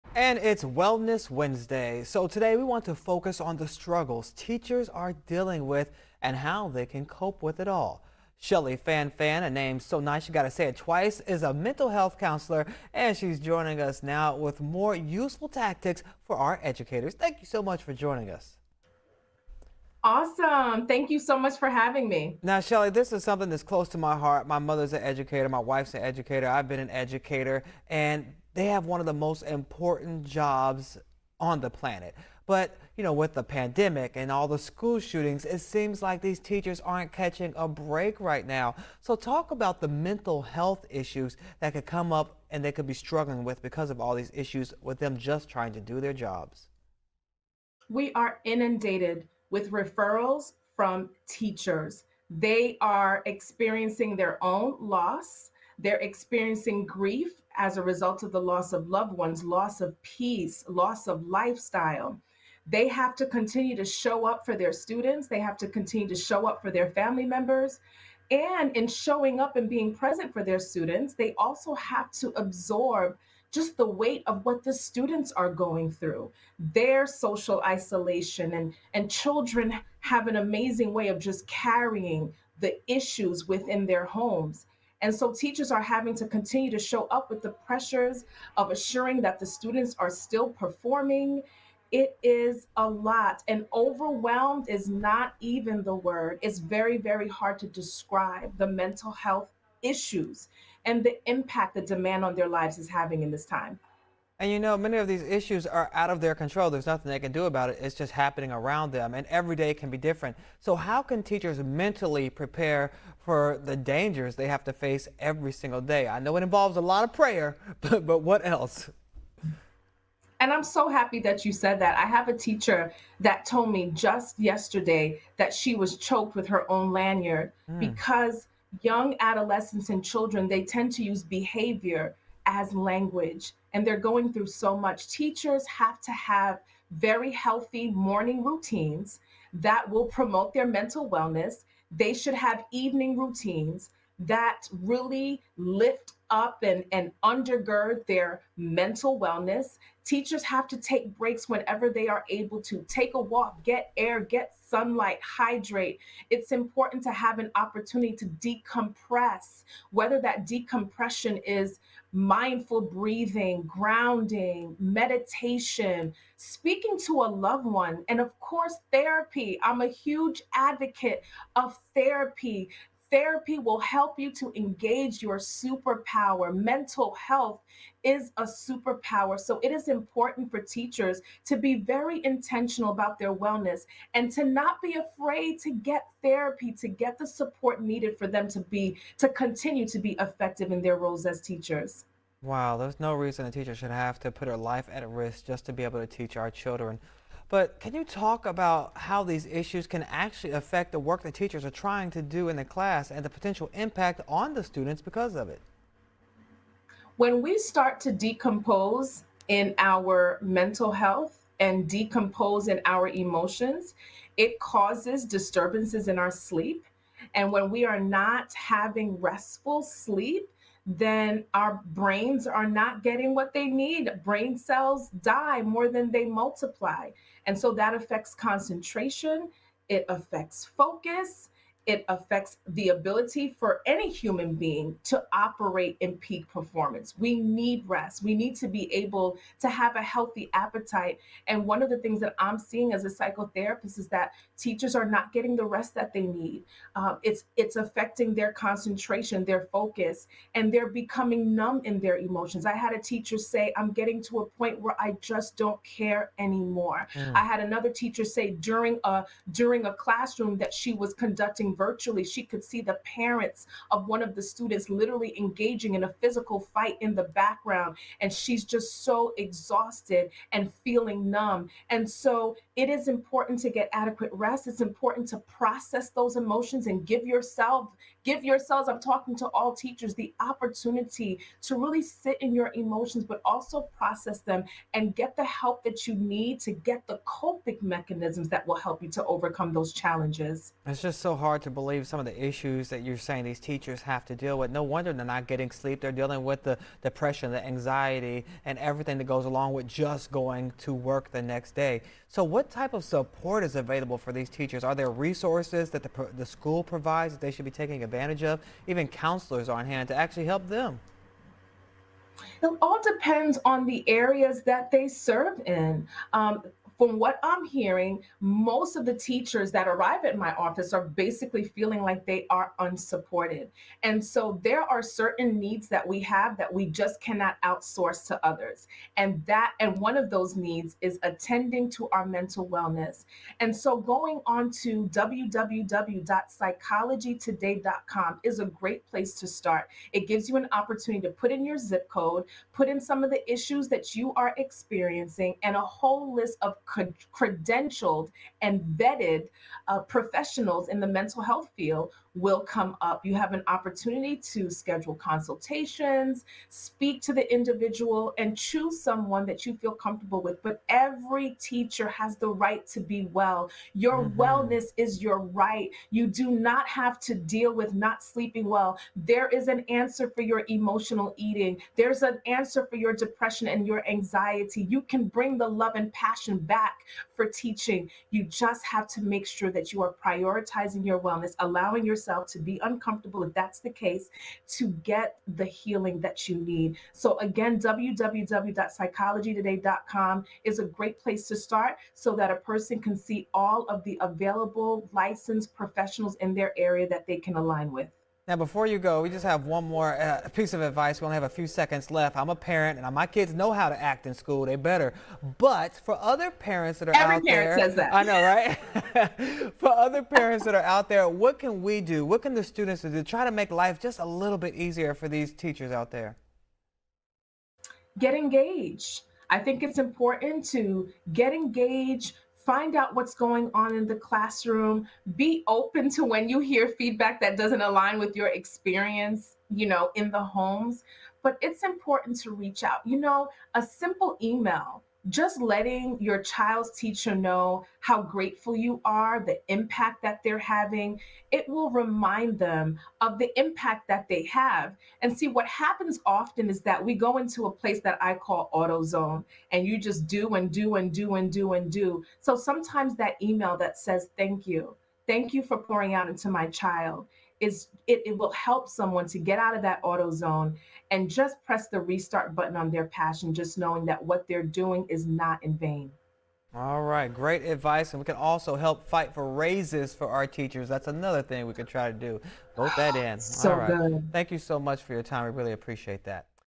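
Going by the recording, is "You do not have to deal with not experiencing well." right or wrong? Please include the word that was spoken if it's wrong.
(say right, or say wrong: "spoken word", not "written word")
wrong: "sleeping", not "experiencing".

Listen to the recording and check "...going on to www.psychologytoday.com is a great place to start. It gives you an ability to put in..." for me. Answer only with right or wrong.
wrong.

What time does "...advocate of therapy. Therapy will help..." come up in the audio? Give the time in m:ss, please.
2:50.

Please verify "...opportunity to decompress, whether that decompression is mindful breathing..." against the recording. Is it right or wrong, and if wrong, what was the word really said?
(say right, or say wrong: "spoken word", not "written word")
right.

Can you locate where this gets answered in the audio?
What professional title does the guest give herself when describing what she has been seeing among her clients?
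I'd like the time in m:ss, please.
4:03.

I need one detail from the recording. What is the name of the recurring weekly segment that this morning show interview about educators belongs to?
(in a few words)
Wellness Wednesday.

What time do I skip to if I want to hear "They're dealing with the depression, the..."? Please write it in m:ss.
4:56.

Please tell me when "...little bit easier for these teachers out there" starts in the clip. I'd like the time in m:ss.
6:54.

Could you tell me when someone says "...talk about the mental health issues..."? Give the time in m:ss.
0:39.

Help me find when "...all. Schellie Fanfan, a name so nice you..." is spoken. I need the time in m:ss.
0:07.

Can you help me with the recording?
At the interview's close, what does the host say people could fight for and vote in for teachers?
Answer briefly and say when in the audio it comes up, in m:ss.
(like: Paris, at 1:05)
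Raises, at 7:49.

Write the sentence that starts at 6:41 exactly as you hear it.
We only have a few seconds left.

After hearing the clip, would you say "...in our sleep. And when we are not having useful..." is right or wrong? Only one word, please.
wrong.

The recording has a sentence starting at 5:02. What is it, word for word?
So, what type of support is available for these teachers?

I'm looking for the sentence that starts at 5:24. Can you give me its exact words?
And so there are certain needs that we have that we just cannot outsource to others.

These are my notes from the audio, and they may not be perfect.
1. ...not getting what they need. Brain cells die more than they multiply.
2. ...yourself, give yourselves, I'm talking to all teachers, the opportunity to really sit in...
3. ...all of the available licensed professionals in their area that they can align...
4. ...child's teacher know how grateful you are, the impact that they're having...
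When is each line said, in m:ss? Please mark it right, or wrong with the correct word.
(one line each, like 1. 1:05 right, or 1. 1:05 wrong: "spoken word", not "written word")
1. 3:42 right
2. 4:37 right
3. 6:33 right
4. 7:16 right.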